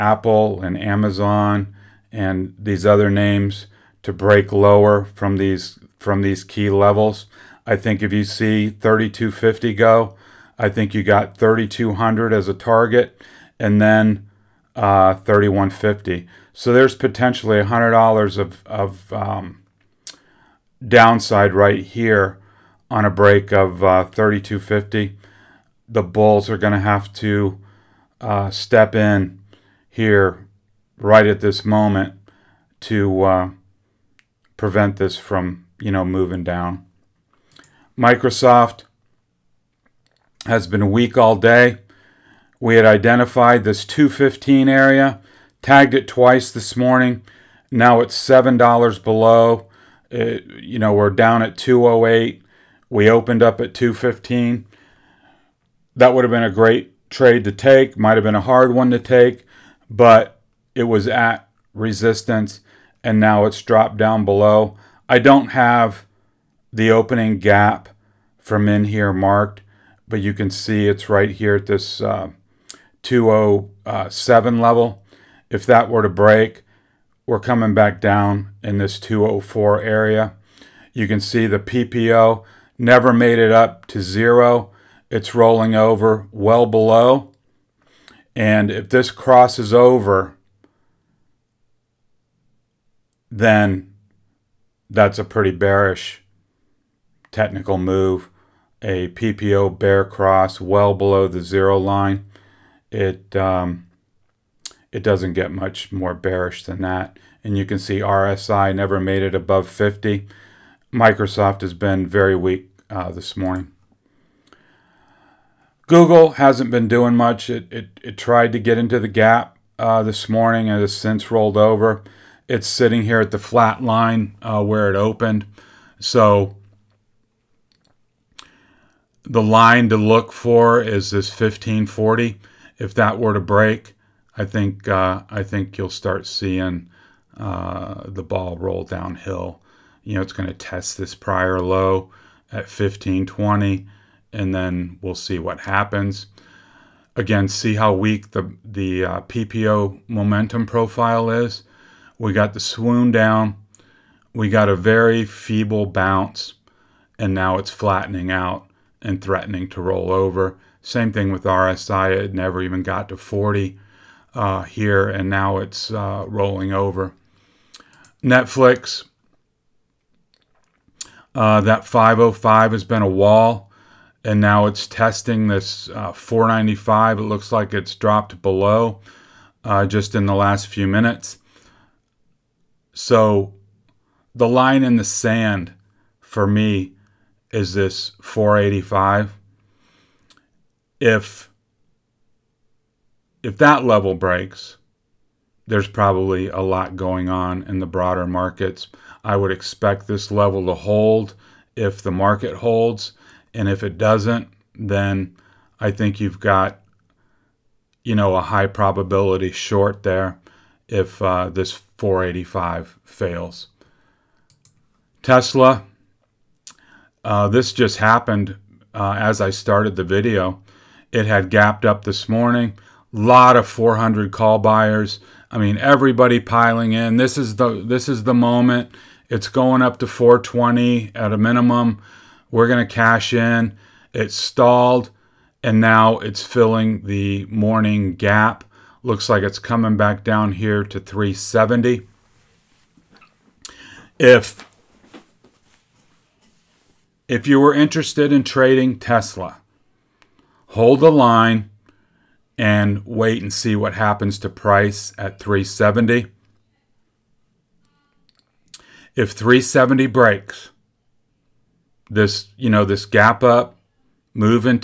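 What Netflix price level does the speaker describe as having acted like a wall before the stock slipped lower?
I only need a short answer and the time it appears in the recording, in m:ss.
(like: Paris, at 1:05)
505, at 2:51.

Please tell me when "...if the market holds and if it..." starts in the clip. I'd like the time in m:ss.
3:21.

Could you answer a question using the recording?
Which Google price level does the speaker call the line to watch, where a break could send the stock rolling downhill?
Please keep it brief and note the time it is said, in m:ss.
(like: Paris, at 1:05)
1540, at 2:11.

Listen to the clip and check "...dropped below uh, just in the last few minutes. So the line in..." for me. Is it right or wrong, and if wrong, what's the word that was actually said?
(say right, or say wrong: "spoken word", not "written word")
right.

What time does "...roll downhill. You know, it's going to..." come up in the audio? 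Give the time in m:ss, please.
2:18.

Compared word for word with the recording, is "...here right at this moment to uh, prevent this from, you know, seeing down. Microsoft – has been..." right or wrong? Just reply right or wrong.
wrong.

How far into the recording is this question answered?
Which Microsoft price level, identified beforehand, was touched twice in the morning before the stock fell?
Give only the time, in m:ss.
0:43.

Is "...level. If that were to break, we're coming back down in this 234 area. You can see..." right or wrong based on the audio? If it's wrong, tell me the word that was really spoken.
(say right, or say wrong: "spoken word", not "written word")
wrong: "204", not "234".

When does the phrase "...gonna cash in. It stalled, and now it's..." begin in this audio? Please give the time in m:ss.
3:52.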